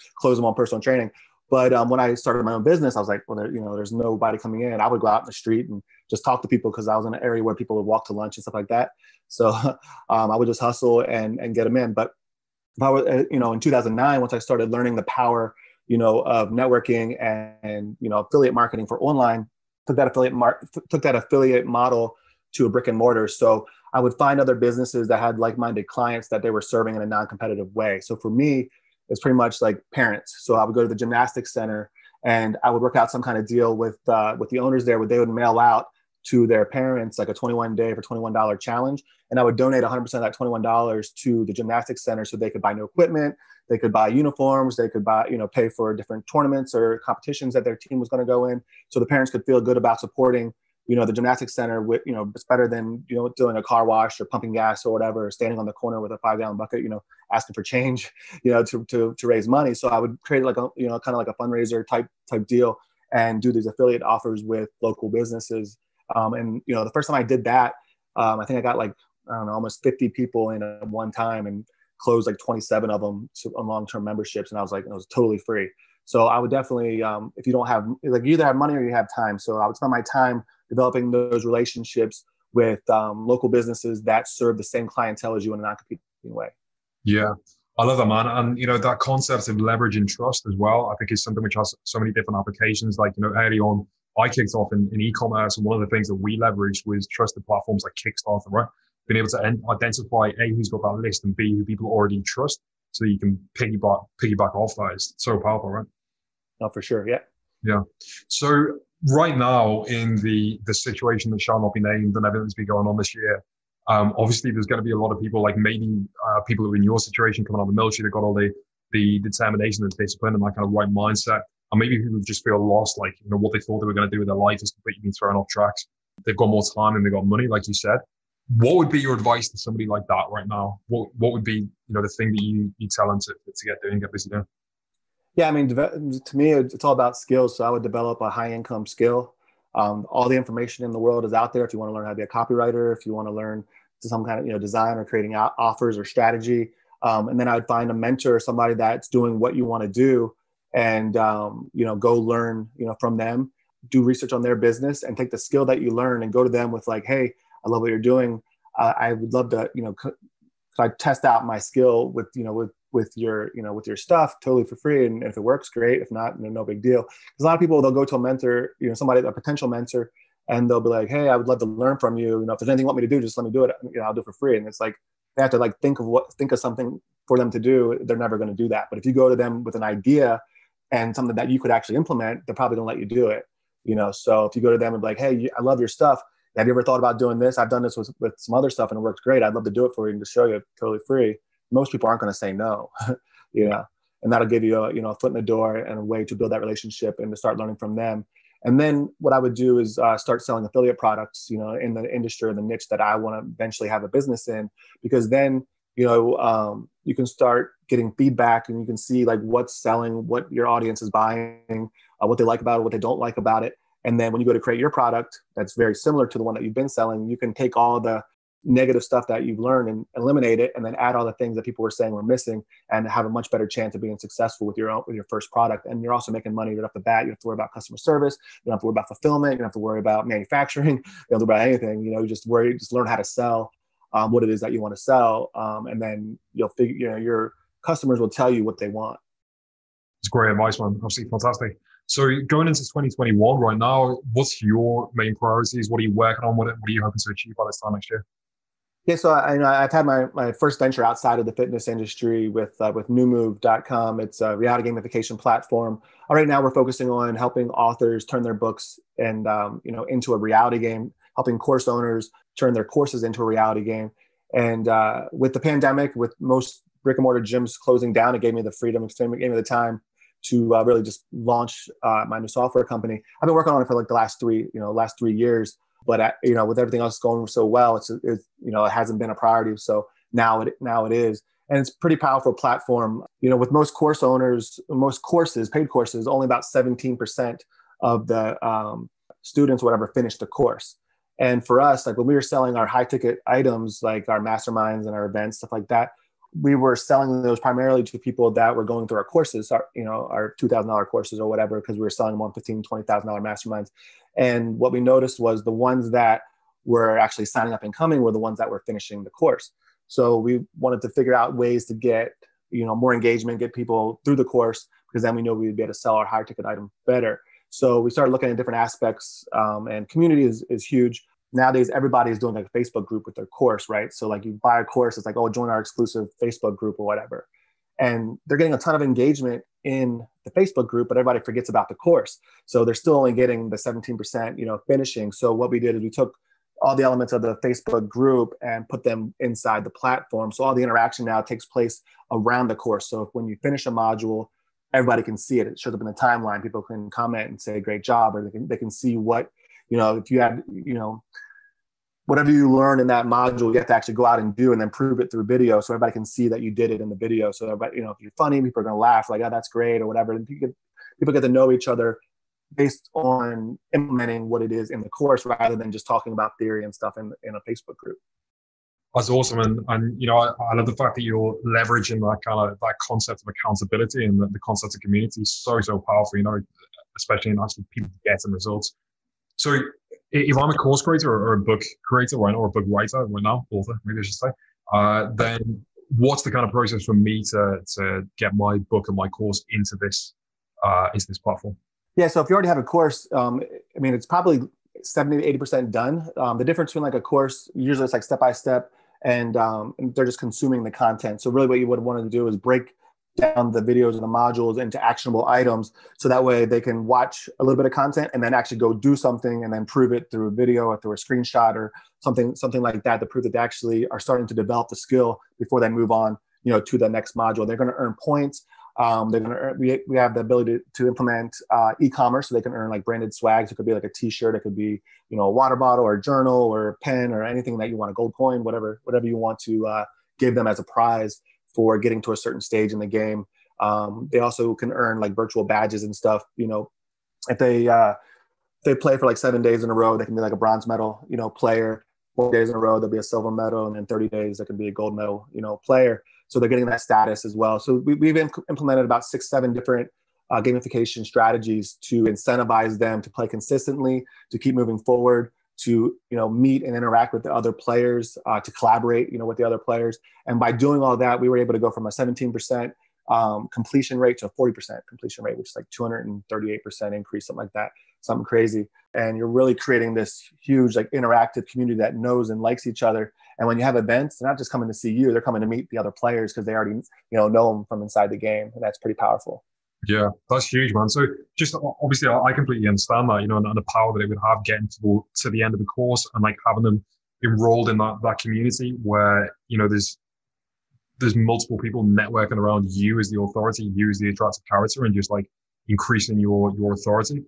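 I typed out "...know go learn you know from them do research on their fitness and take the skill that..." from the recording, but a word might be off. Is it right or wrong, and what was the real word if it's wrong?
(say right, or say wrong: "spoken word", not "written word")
wrong: "business", not "fitness".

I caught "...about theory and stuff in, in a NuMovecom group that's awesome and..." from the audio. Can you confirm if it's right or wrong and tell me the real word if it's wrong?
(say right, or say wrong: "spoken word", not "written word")
wrong: "Facebook", not "NuMovecom".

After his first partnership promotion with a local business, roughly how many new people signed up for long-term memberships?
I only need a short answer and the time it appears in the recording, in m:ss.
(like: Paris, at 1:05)
27, at 1:12.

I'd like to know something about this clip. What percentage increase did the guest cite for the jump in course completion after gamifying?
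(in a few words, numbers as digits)
238%.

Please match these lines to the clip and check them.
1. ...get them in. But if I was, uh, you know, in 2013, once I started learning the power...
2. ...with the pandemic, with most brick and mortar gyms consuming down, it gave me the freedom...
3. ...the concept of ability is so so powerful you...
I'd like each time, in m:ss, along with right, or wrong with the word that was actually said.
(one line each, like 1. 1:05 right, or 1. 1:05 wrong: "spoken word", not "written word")
1. 0:11 wrong: "2009", not "2013"
2. 4:25 wrong: "closing", not "consuming"
3. 6:14 wrong: "community", not "ability".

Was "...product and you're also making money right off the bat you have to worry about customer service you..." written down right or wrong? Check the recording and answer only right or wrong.
right.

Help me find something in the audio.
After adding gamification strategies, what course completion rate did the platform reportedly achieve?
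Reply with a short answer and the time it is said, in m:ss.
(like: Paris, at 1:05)
40%, at 7:44.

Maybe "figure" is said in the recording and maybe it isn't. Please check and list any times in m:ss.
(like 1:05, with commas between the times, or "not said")
3:56, 5:11.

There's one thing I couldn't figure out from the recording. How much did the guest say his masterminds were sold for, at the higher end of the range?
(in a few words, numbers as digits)
$20,000.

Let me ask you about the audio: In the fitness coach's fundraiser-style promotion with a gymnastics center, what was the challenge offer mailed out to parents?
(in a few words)
21 days for $21.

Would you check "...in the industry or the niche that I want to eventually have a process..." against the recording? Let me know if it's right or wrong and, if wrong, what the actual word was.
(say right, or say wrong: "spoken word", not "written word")
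wrong: "business", not "process".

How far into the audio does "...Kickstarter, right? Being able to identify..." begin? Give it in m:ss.
1:37.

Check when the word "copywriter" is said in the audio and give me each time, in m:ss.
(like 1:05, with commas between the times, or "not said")
2:22.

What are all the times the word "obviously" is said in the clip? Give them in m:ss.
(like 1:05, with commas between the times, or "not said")
1:54, 4:01, 8:02.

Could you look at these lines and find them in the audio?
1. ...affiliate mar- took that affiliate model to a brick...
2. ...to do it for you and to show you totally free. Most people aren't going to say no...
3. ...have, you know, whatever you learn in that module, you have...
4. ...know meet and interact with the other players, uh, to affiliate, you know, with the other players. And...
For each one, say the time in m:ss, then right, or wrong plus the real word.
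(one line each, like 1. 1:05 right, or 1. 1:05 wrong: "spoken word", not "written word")
1. 0:20 right
2. 3:09 right
3. 5:50 right
4. 7:36 wrong: "collaborate", not "affiliate".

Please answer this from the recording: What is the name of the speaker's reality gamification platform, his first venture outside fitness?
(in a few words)
NuMove.com.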